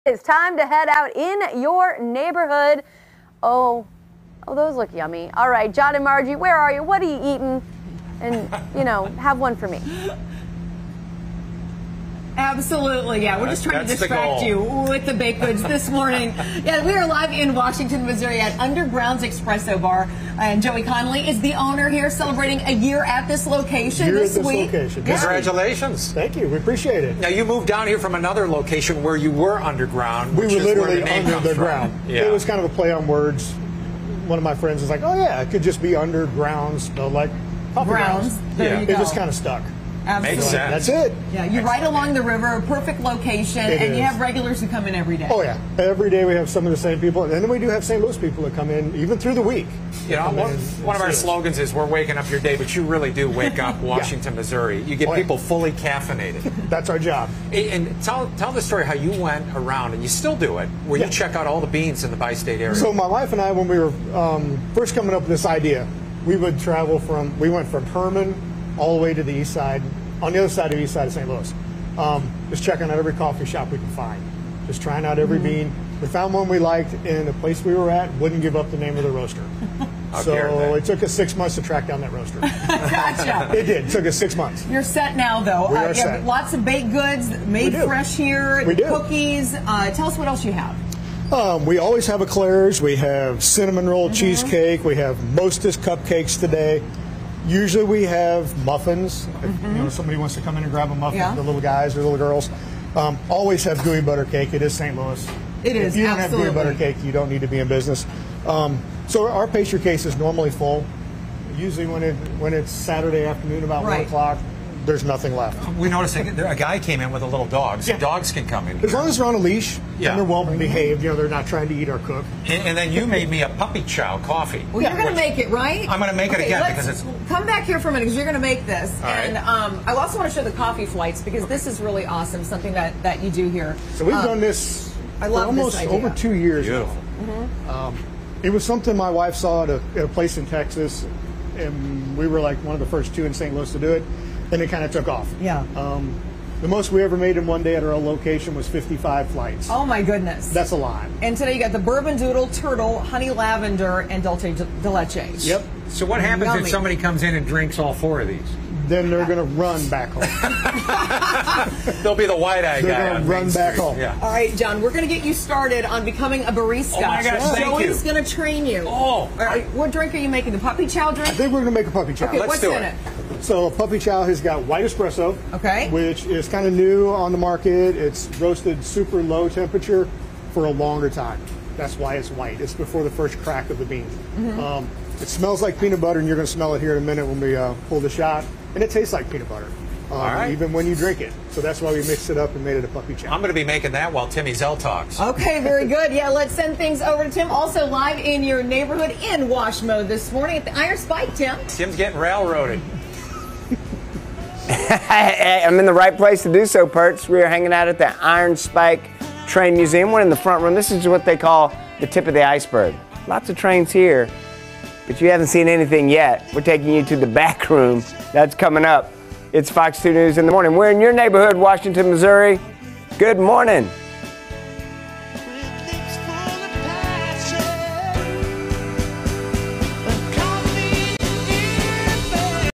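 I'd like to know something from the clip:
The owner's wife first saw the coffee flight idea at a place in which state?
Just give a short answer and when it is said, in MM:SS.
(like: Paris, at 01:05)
Texas, at 02:20.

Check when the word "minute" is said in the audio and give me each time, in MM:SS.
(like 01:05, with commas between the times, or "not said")
02:07, 03:07.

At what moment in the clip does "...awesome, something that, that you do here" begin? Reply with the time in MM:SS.
02:12.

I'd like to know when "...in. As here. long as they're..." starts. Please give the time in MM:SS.
01:58.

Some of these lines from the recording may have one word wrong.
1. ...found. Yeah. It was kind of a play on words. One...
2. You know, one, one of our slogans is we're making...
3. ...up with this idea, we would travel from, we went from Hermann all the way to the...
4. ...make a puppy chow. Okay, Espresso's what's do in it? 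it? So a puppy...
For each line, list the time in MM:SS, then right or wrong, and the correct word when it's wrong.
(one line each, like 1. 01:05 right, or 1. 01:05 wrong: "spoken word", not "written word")
1. 00:31 wrong: "ground", not "found"
2. 00:50 wrong: "waking", not "making"
3. 01:05 right
4. 02:51 wrong: "Let", not "Espresso".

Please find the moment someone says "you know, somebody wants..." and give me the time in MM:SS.
01:39.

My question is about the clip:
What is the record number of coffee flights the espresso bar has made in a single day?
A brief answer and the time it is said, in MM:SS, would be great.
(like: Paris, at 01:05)
55, at 02:28.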